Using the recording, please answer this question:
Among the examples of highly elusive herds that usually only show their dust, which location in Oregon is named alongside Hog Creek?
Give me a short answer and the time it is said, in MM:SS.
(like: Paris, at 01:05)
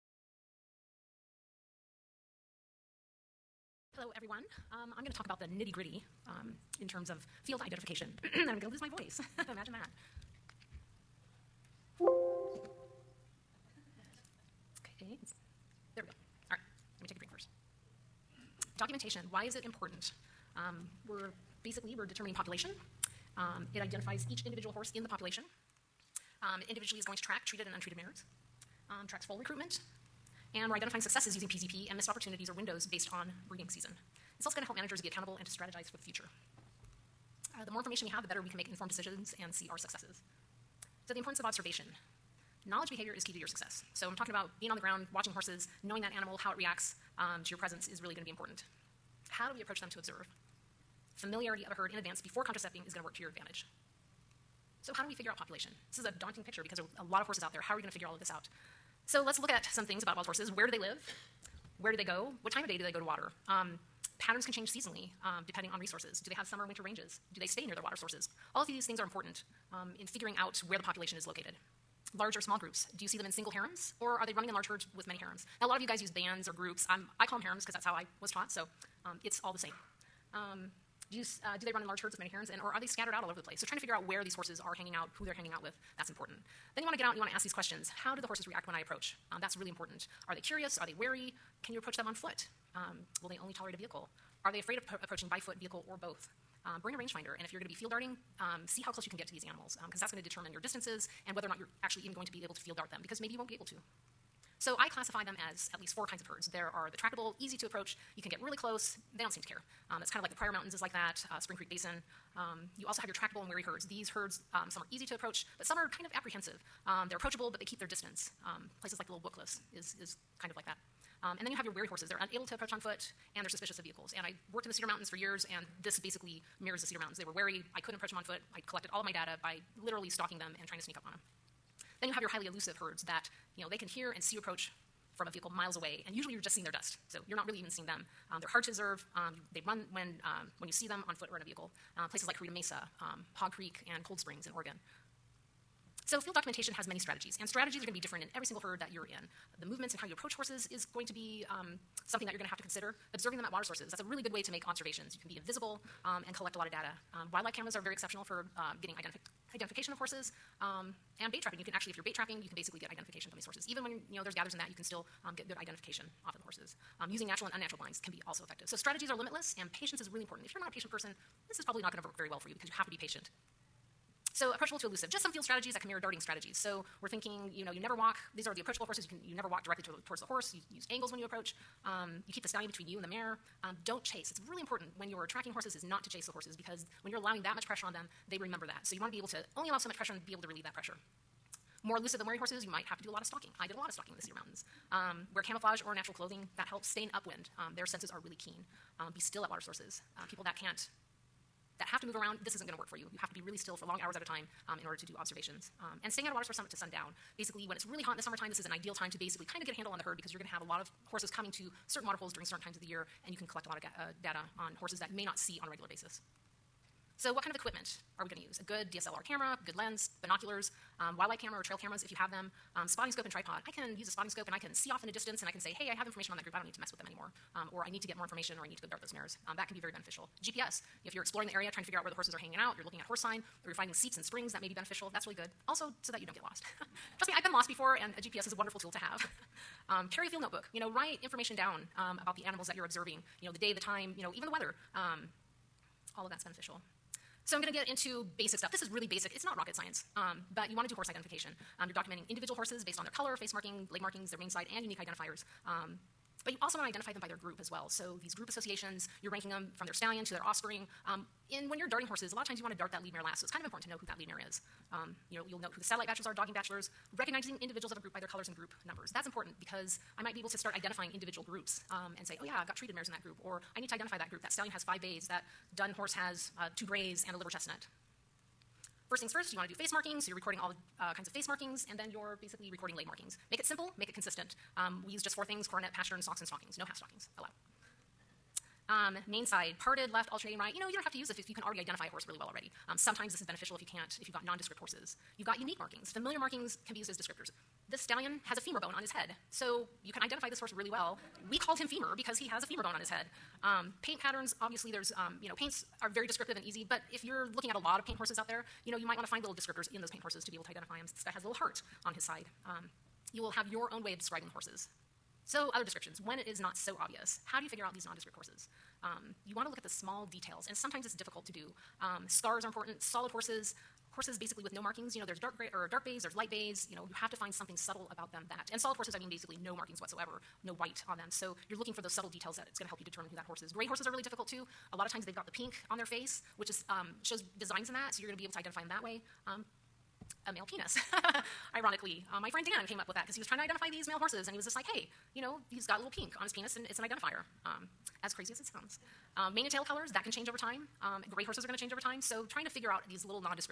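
Cold Springs, at 02:24.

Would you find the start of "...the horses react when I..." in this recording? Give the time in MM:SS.
01:28.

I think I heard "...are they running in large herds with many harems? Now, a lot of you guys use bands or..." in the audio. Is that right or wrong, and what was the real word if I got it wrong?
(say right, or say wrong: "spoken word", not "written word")
right.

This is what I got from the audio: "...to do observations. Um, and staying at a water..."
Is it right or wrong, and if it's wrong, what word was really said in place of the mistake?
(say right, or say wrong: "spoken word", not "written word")
right.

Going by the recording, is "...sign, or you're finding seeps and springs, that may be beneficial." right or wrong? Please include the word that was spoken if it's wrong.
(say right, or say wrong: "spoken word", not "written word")
right.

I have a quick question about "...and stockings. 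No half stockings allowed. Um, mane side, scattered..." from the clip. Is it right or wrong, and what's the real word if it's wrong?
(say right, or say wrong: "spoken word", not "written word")
wrong: "parted", not "scattered".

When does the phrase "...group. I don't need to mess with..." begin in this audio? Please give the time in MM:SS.
03:46.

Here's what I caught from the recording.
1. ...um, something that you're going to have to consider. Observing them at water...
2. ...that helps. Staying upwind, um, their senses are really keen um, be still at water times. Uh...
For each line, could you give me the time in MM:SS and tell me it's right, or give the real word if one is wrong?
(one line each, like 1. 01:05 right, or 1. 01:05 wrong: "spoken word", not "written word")
1. 02:31 right
2. 03:16 wrong: "sources", not "times".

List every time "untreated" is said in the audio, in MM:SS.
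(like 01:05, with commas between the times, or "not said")
00:27.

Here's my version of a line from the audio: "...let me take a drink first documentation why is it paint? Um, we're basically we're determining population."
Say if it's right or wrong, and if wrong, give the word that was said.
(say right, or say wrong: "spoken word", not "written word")
wrong: "important", not "paint".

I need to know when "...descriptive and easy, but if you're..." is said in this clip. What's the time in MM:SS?
05:06.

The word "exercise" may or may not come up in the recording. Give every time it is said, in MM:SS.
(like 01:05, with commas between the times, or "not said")
not said.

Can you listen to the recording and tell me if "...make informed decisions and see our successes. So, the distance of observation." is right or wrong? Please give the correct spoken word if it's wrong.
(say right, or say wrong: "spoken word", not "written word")
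wrong: "importance", not "distance".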